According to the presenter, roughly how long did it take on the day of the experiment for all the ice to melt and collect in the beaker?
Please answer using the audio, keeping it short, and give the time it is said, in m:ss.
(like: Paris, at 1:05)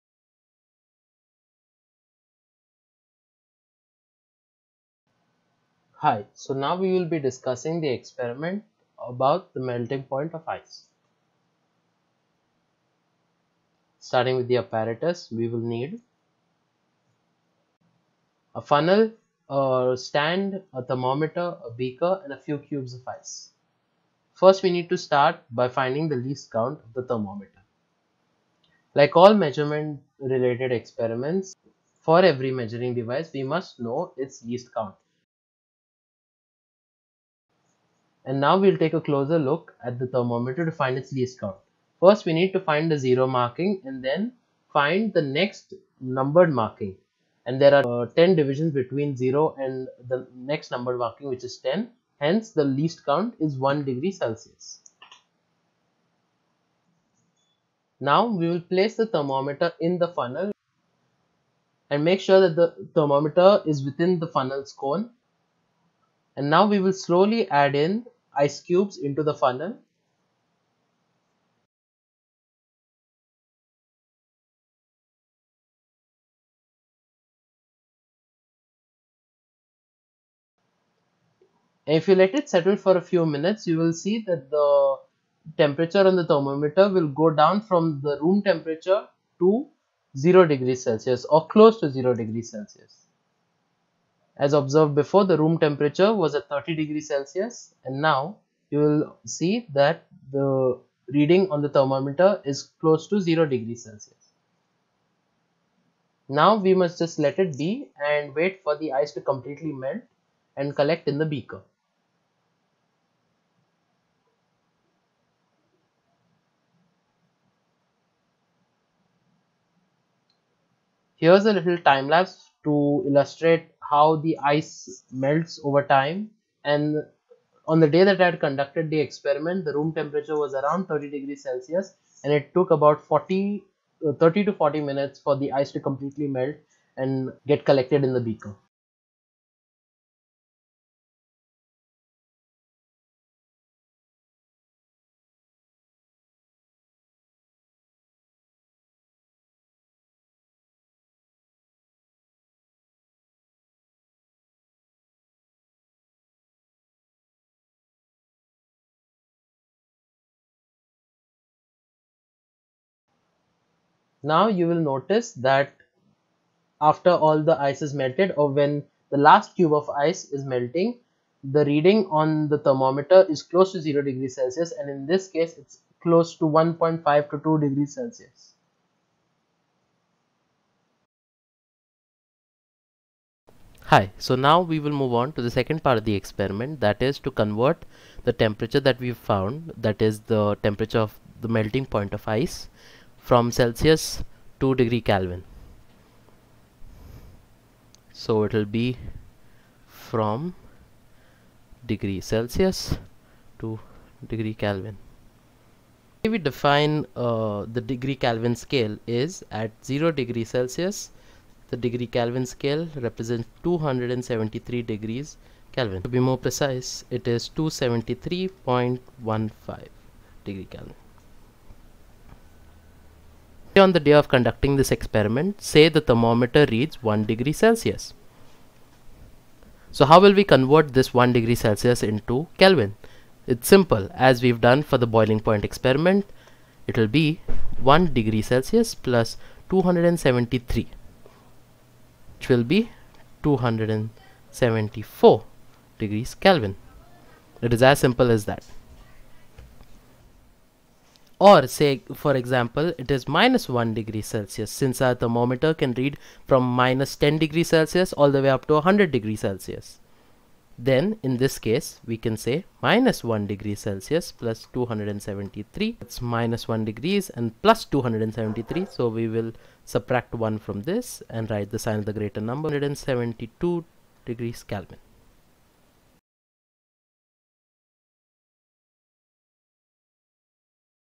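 30 to 40 minutes, at 2:14.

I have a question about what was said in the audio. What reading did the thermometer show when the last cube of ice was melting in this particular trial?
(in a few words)
1.5 to 2 degrees Celsius.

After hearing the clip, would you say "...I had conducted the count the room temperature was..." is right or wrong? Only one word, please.
wrong.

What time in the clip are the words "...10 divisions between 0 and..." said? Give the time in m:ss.
0:48.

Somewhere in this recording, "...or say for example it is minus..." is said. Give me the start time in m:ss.
4:11.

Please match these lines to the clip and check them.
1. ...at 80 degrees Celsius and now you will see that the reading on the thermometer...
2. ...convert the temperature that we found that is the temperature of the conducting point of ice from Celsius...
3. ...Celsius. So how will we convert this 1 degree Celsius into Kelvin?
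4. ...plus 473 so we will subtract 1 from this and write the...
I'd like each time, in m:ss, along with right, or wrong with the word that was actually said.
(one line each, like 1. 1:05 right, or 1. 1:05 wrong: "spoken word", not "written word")
1. 1:36 wrong: "30", not "80"
2. 3:07 wrong: "melting", not "conducting"
3. 3:47 right
4. 4:27 wrong: "273", not "473".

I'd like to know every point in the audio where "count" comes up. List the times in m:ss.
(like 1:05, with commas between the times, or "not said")
0:26, 0:34, 0:41, 0:53.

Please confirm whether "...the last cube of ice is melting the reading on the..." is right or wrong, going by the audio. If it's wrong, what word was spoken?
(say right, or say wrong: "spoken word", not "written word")
right.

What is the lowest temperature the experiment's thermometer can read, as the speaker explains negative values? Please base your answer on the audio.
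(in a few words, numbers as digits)
-10 degrees Celsius.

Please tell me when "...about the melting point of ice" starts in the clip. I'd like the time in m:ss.
0:09.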